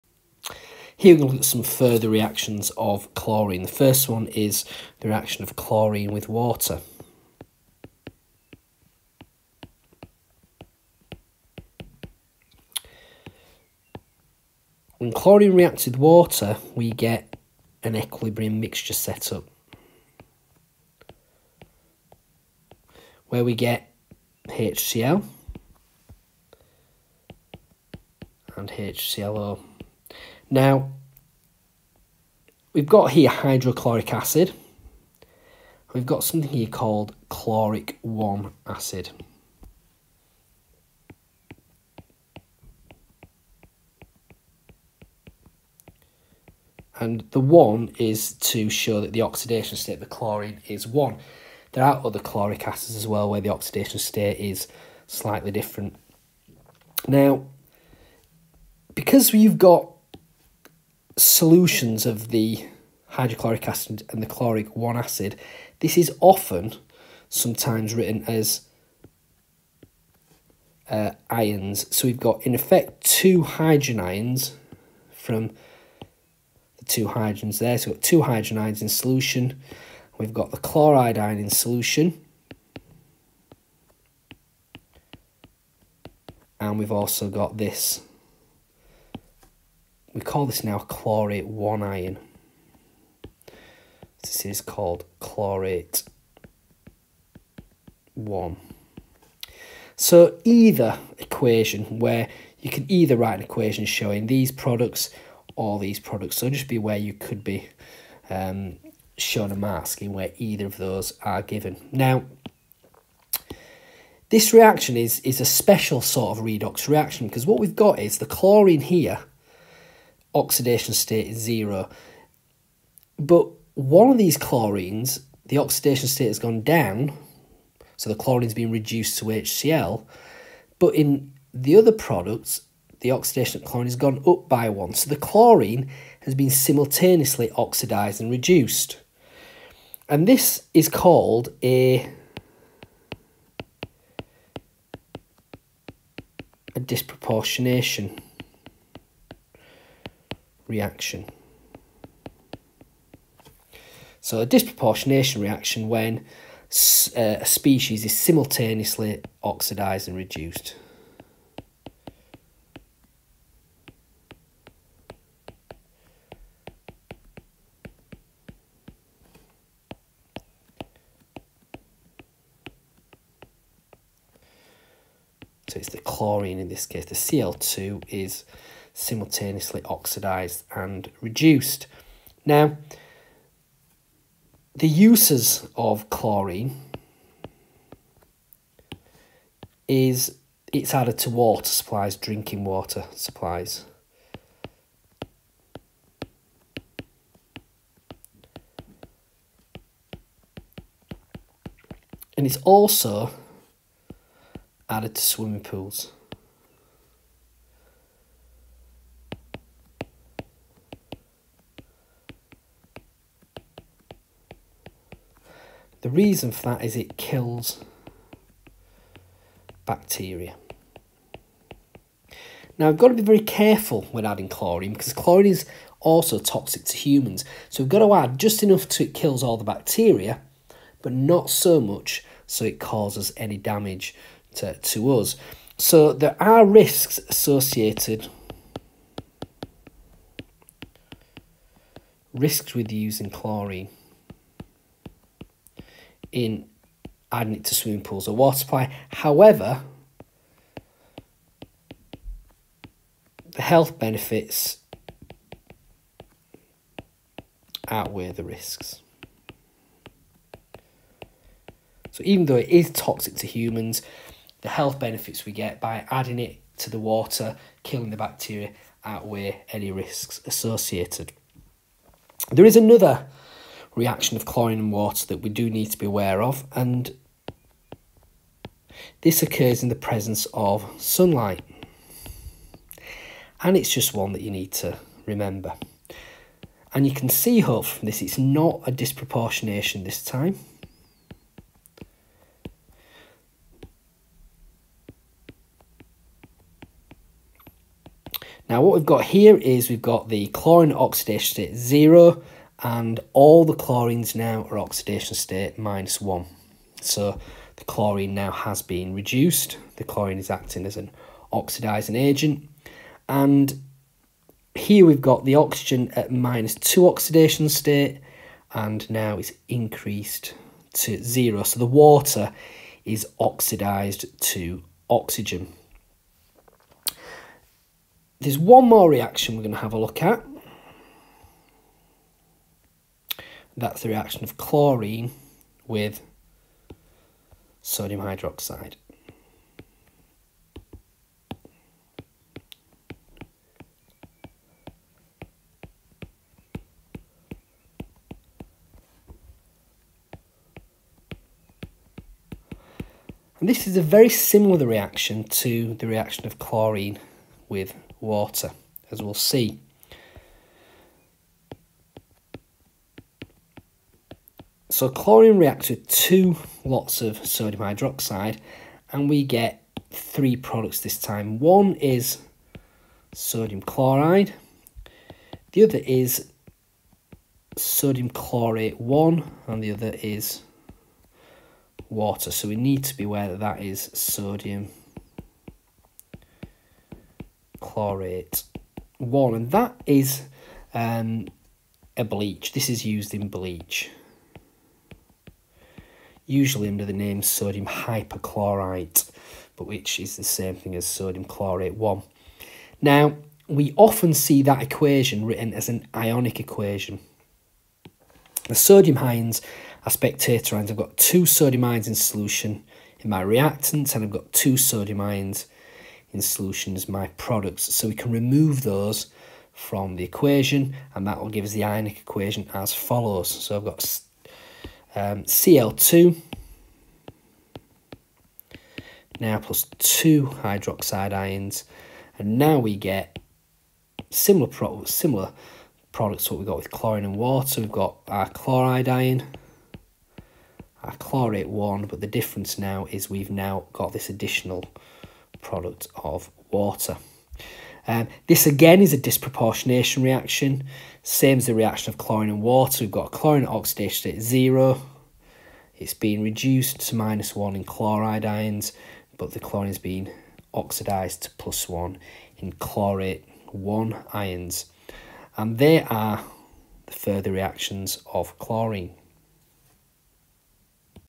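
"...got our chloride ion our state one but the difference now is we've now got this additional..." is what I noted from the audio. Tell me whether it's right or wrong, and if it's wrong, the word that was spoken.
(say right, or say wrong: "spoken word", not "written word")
wrong: "chlorate", not "state".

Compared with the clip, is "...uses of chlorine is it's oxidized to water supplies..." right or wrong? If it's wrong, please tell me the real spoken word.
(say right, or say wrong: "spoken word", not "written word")
wrong: "added", not "oxidized".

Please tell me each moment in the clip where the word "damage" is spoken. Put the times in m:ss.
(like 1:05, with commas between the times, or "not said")
3:53.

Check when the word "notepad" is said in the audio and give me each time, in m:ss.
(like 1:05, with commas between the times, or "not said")
not said.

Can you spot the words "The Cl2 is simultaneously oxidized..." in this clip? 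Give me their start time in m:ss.
2:57.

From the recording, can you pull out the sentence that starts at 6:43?
Now, we often see that equation written as an ionic equation.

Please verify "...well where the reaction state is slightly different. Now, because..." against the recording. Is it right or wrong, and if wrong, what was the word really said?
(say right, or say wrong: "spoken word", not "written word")
wrong: "oxidation", not "reaction".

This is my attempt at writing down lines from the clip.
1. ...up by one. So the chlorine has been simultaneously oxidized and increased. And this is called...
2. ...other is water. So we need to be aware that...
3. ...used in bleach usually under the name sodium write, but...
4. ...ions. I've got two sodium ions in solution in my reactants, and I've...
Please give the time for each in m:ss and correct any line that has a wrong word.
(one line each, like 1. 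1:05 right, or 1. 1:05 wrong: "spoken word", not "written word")
1. 2:14 wrong: "reduced", not "increased"
2. 6:19 right
3. 6:33 wrong: "hypochlorite", not "write"
4. 6:50 right.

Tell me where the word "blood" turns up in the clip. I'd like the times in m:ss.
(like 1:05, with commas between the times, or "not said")
not said.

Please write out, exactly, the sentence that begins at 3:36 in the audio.
The reason for that is it kills bacteria.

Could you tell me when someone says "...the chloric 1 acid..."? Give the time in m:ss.
1:04.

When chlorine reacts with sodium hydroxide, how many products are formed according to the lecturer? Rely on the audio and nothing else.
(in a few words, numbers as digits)
3.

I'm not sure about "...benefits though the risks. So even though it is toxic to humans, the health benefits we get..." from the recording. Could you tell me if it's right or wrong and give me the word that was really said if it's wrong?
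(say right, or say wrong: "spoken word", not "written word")
wrong: "outweigh", not "though".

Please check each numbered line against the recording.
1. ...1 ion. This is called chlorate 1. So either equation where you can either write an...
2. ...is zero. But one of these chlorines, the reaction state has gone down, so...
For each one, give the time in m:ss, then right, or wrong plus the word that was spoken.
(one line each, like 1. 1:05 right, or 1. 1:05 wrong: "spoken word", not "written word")
1. 1:31 right
2. 2:01 wrong: "oxidation", not "reaction".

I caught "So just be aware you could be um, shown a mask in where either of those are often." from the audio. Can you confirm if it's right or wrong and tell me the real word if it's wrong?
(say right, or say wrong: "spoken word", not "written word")
wrong: "given", not "often".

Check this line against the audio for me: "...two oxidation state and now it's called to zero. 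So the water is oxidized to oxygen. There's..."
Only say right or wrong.
wrong.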